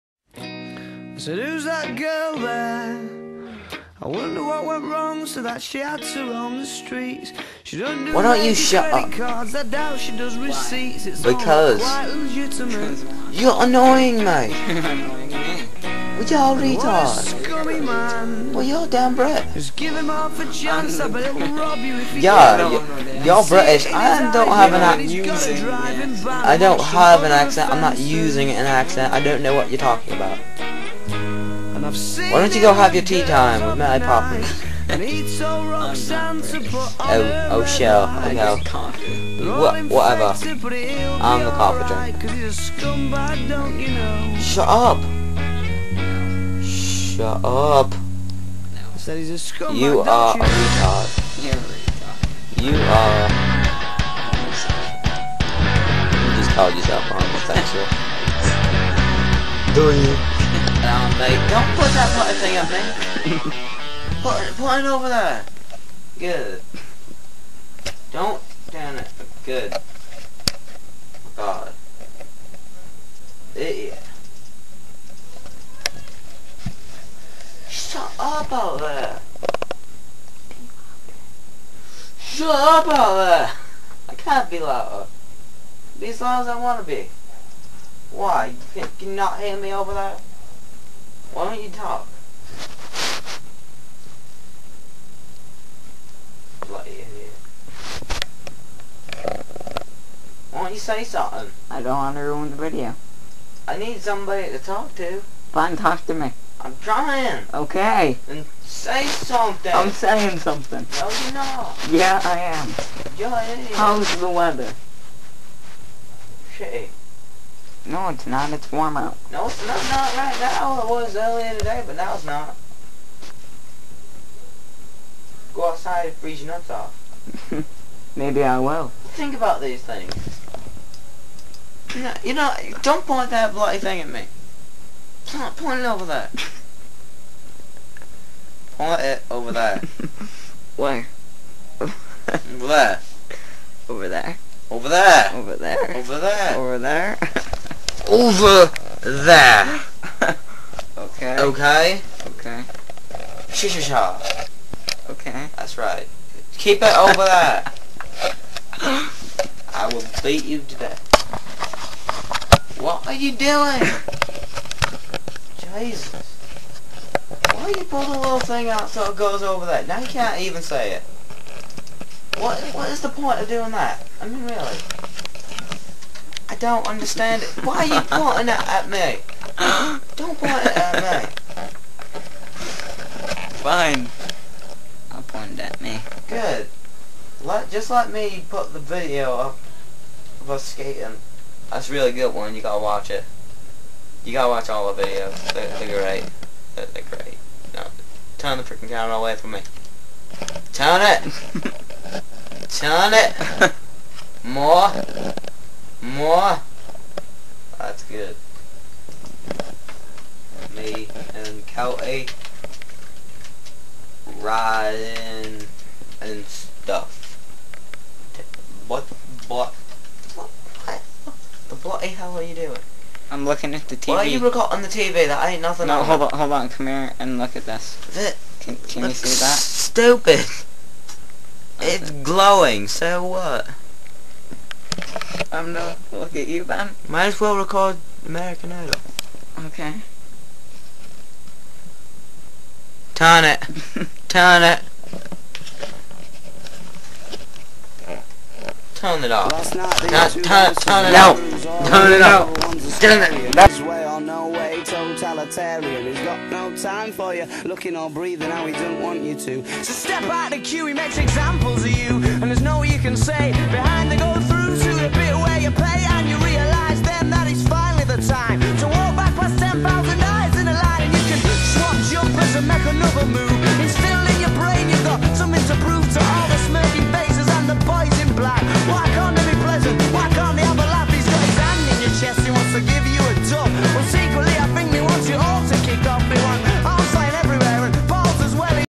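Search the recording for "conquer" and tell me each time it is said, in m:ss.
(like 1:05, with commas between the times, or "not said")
not said.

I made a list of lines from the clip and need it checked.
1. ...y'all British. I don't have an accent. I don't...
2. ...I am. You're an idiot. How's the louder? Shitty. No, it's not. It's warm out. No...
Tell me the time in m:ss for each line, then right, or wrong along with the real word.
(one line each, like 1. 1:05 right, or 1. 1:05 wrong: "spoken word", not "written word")
1. 0:23 right
2. 1:52 wrong: "weather", not "louder".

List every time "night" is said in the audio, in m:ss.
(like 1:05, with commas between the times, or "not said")
4:09.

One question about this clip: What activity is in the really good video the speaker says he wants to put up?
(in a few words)
Skating.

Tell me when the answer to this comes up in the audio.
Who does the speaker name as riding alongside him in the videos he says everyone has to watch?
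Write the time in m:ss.
3:31.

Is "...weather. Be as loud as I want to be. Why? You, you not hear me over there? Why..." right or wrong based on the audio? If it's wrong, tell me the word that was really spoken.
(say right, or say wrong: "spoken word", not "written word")
wrong: "louder", not "weather".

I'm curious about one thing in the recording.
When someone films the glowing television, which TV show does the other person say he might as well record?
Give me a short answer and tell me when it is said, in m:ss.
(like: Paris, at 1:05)
American Idol, at 3:58.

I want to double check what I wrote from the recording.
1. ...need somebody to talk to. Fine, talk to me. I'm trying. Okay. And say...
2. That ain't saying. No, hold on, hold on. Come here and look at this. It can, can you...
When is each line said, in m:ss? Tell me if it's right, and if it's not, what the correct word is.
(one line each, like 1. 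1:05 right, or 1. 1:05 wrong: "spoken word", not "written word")
1. 1:43 right
2. 3:45 wrong: "nothing", not "saying".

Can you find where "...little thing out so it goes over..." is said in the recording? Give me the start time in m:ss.
2:48.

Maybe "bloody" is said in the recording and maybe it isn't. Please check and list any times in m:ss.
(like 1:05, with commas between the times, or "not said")
1:36, 2:13, 3:41.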